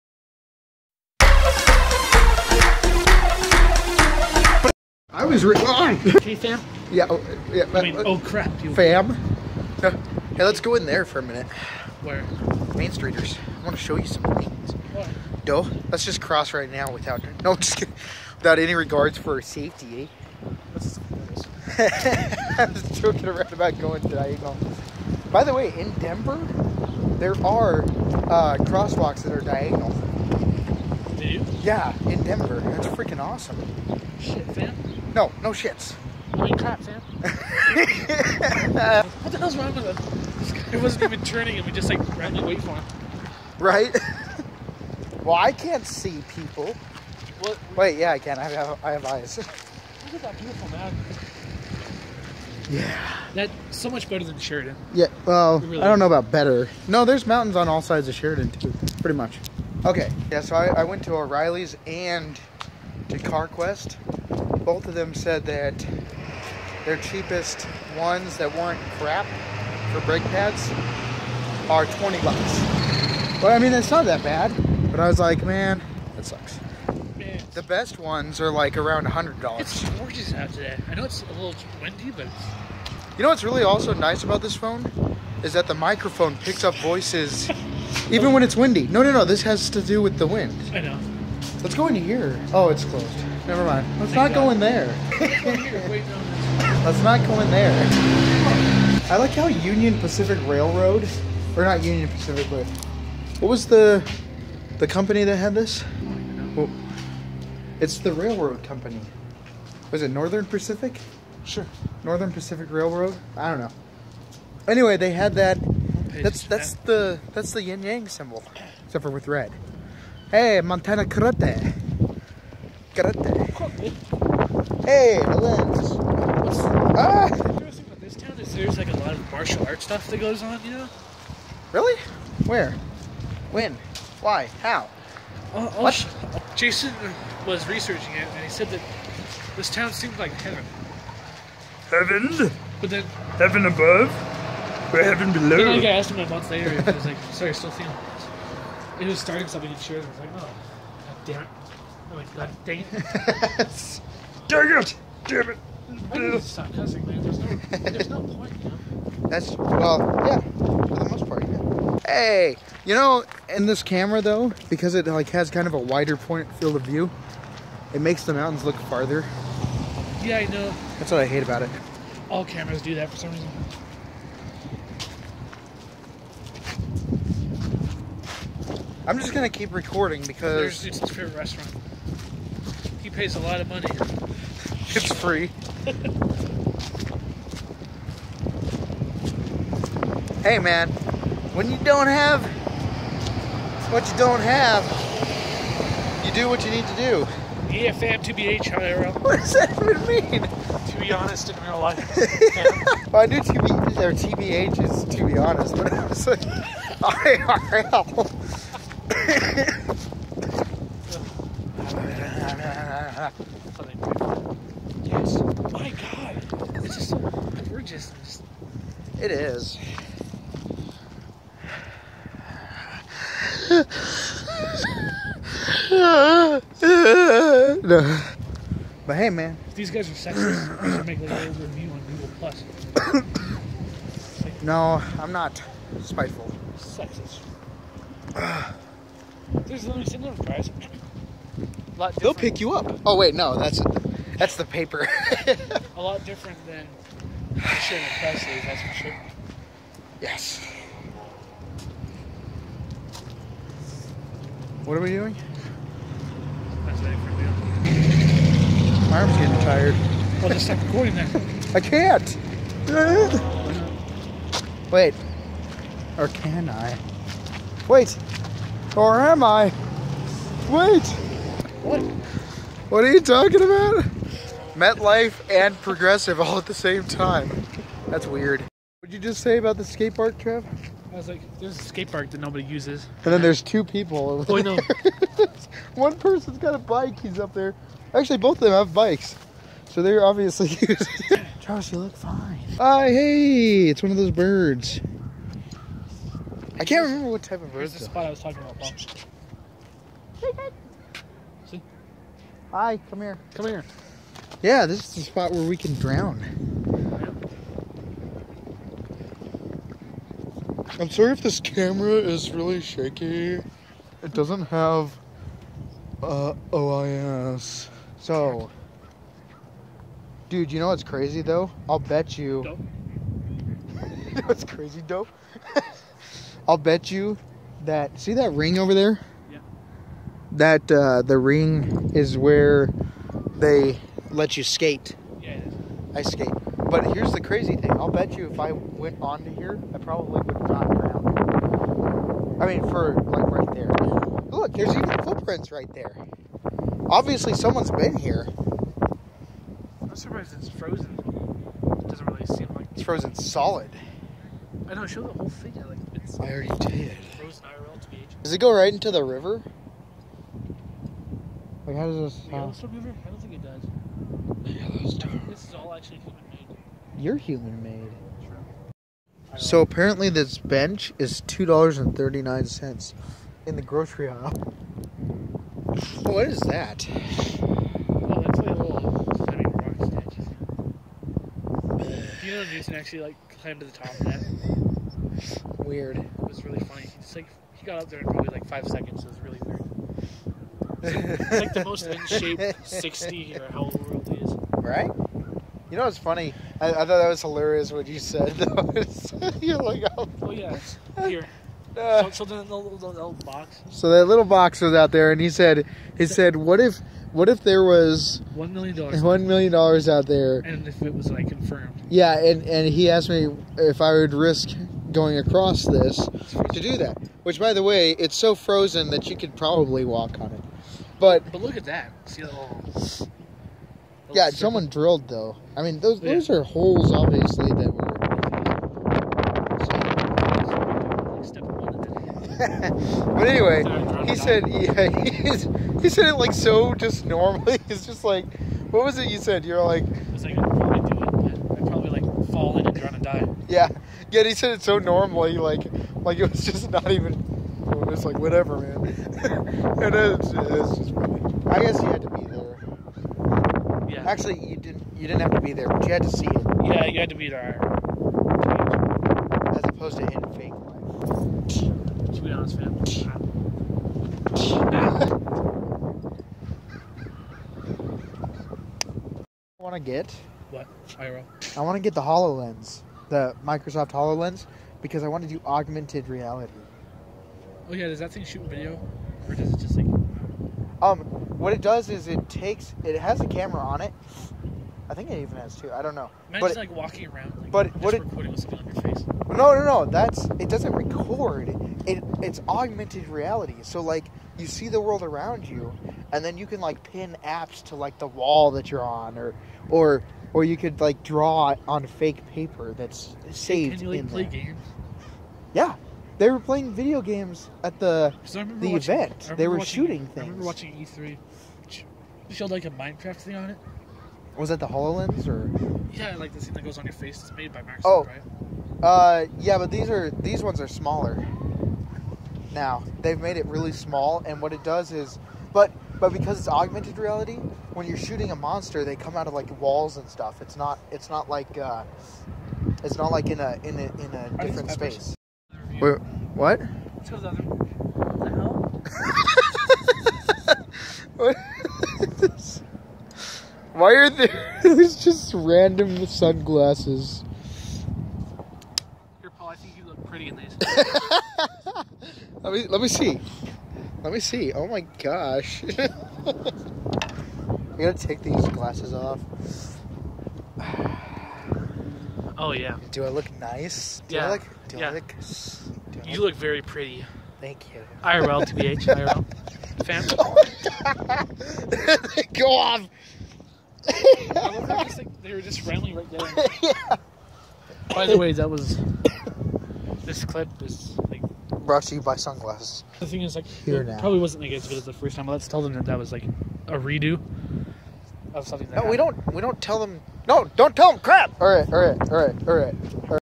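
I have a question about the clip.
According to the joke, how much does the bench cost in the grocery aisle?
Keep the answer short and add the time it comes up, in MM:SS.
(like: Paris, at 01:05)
$2.39, at 06:11.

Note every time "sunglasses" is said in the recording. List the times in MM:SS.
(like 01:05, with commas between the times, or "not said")
09:06, 09:42.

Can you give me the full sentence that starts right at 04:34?
MetLife and Progressive all at the same time.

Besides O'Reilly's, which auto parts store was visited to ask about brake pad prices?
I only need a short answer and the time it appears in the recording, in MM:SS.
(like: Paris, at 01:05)
CarQuest, at 01:03.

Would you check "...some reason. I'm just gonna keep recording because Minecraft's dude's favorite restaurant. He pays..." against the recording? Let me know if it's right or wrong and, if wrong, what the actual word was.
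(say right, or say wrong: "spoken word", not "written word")
wrong: "There", not "Minecraft".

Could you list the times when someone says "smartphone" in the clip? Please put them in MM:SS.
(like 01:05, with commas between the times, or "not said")
not said.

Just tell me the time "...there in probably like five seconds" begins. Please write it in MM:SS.
06:28.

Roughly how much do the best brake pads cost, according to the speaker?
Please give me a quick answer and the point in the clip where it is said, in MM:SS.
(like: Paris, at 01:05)
$100, at 01:18.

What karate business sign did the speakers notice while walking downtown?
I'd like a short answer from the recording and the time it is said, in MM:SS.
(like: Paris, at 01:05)
Montana Karate, at 02:00.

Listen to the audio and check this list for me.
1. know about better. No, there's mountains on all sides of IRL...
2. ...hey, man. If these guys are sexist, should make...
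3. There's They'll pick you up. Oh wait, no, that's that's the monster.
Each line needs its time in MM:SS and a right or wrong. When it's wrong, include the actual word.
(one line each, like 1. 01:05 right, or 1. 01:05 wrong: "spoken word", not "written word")
1. 00:55 wrong: "Sheridan", not "IRL"
2. 03:49 right
3. 03:59 wrong: "paper", not "monster".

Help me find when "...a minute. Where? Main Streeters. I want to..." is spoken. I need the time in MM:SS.
00:11.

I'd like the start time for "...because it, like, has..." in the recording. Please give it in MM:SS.
02:44.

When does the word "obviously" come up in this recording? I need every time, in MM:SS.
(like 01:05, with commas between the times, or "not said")
04:50, 05:47, 07:07.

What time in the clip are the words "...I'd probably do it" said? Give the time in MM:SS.
07:20.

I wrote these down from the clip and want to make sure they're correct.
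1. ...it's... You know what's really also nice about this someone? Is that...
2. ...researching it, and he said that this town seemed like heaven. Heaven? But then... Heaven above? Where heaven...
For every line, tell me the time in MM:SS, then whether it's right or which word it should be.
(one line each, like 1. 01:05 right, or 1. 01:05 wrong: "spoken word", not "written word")
1. 01:22 wrong: "phone", not "someone"
2. 02:17 right.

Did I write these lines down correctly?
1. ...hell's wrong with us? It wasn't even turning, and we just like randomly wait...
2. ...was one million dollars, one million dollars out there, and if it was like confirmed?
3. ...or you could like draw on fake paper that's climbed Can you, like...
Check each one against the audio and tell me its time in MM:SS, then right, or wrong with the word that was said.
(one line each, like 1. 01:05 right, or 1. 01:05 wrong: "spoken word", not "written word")
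1. 00:39 right
2. 06:47 right
3. 08:20 wrong: "saved", not "climbed".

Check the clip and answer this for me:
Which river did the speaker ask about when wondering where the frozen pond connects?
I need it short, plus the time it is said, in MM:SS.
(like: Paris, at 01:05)
Yellowstone River, at 06:02.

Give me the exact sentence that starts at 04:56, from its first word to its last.
I can't remember what type of bird.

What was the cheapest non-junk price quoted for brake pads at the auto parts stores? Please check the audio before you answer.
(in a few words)
$20.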